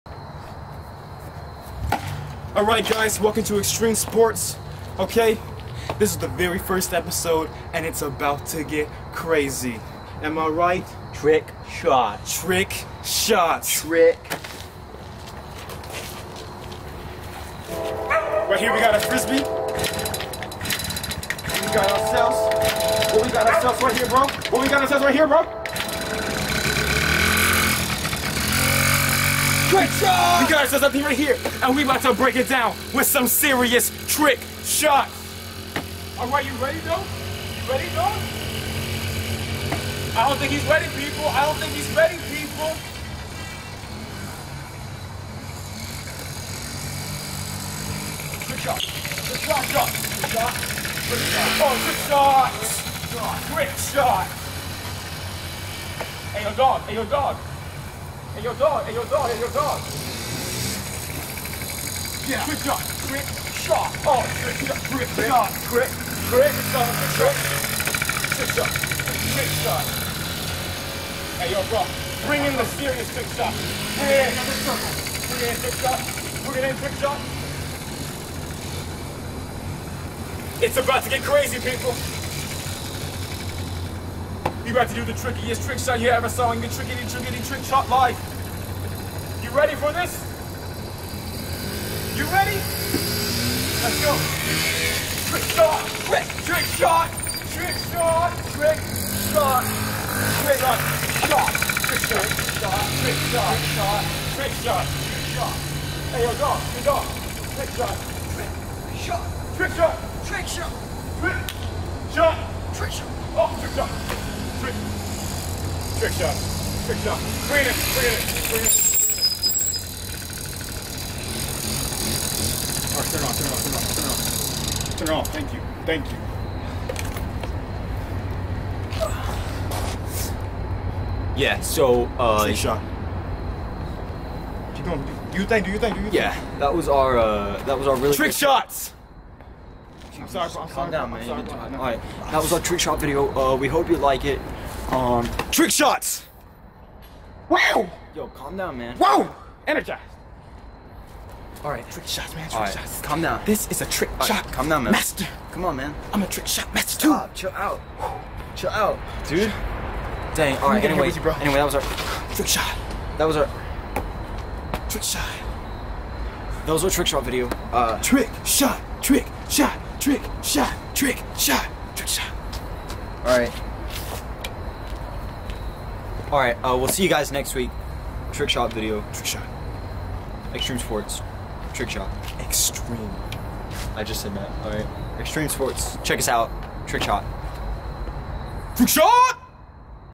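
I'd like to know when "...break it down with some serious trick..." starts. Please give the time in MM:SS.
00:32.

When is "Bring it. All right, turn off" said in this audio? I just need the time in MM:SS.
01:58.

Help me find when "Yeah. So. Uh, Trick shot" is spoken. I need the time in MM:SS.
02:11.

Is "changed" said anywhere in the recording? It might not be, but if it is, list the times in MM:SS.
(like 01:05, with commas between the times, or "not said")
not said.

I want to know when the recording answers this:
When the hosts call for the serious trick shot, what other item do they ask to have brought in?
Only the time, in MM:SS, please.
01:14.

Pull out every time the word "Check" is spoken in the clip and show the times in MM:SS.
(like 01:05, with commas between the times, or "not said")
03:06.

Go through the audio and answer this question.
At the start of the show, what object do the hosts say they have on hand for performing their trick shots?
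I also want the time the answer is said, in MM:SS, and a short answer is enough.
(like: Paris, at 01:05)
frisbee, at 00:18.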